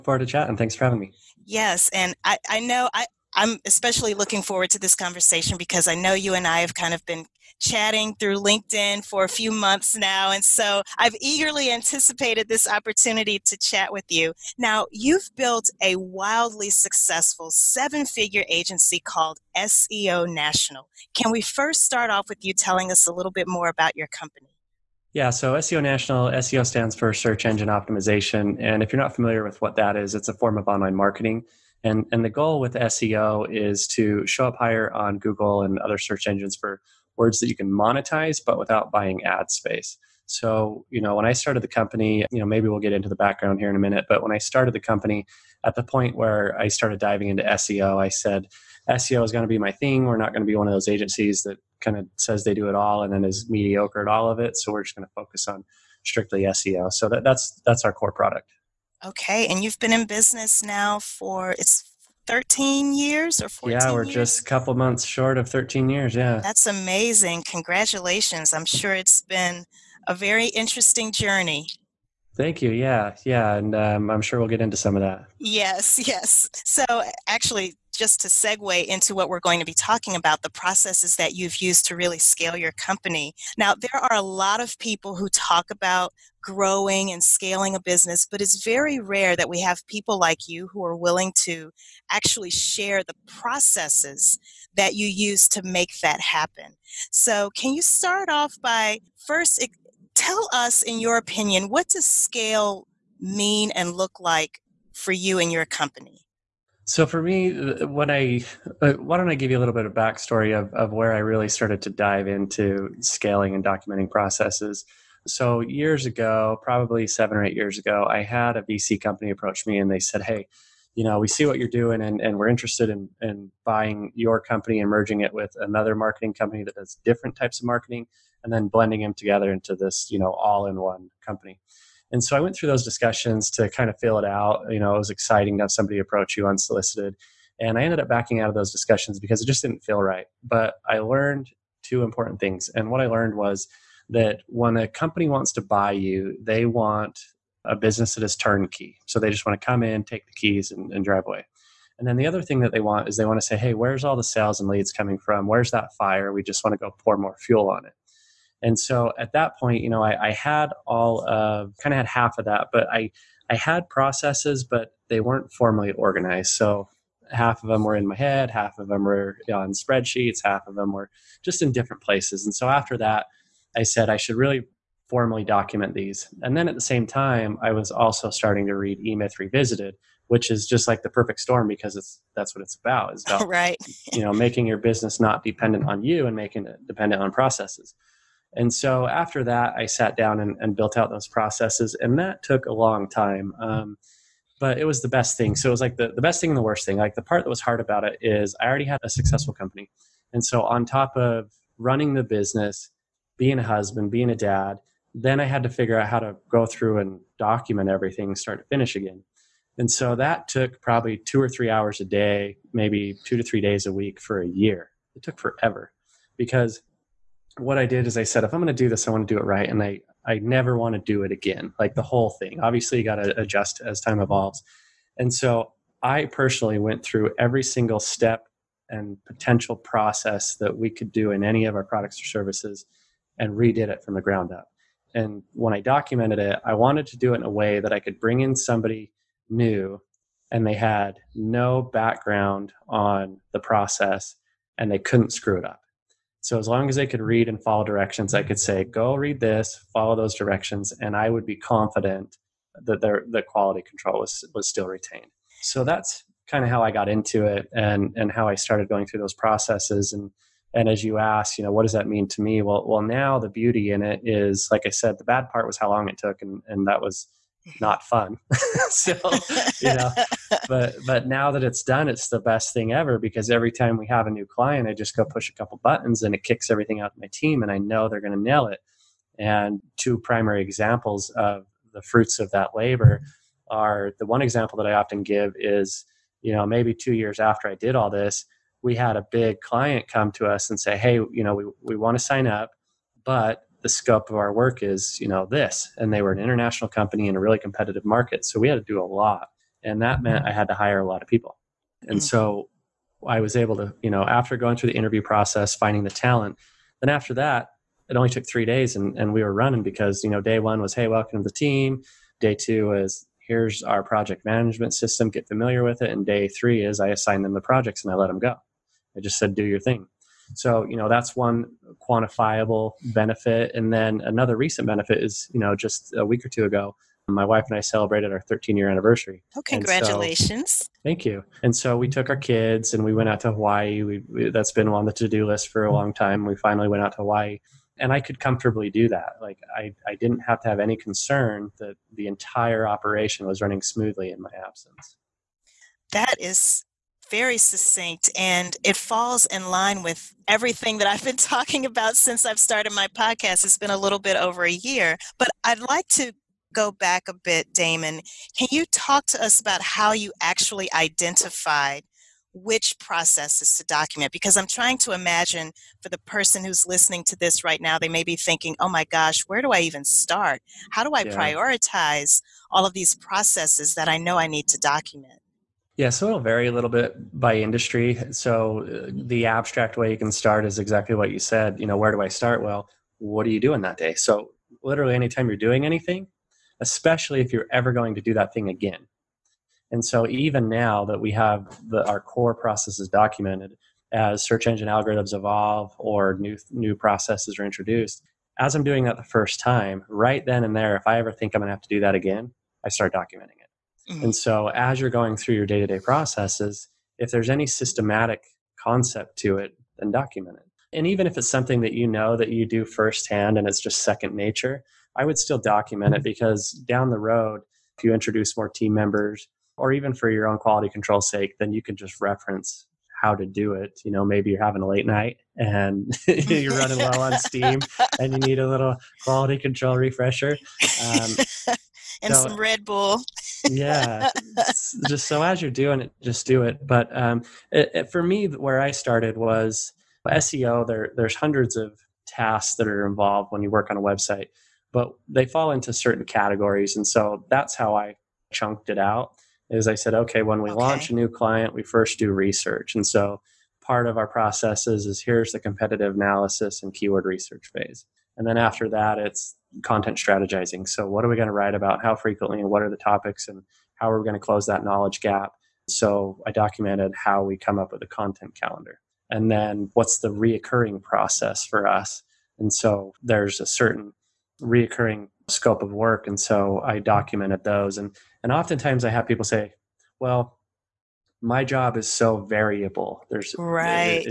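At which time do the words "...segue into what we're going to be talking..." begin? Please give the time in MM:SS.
01:18.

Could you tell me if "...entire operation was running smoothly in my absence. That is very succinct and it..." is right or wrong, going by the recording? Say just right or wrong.
right.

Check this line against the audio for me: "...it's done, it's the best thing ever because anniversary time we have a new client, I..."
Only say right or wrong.
wrong.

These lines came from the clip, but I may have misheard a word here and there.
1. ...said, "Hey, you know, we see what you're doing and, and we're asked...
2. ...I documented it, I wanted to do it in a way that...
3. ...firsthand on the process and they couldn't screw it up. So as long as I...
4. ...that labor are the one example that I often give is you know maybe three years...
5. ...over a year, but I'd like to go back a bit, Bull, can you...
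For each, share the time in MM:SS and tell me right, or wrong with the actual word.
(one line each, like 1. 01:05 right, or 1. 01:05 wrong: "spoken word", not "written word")
1. 01:59 wrong: "interested", not "asked"
2. 03:55 right
3. 04:01 wrong: "background", not "firsthand"
4. 04:42 wrong: "two", not "three"
5. 05:54 wrong: "Damon", not "Bull".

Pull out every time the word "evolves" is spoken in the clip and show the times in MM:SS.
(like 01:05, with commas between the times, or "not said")
03:44, 06:35.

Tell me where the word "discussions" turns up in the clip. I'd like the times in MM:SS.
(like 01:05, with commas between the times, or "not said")
02:12, 02:18.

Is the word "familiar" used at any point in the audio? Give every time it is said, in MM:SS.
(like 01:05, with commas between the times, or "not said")
00:29, 05:15.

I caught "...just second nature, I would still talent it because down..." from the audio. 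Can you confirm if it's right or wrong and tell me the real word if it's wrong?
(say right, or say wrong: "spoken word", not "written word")
wrong: "document", not "talent".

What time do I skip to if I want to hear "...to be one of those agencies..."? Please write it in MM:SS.
00:50.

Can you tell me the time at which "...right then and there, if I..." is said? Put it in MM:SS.
06:40.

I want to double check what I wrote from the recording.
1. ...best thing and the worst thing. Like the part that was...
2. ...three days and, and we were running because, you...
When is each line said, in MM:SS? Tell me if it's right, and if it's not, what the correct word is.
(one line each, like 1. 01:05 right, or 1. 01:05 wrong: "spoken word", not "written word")
1. 03:16 right
2. 05:08 right.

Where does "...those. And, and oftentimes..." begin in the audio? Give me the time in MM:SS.
07:57.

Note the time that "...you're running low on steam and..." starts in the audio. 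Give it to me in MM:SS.
07:06.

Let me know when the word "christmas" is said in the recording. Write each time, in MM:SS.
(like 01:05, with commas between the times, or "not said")
not said.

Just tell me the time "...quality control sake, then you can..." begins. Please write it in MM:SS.
07:00.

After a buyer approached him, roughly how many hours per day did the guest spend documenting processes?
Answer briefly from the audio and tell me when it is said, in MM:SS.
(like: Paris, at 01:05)
2 or 3 hours, at 03:31.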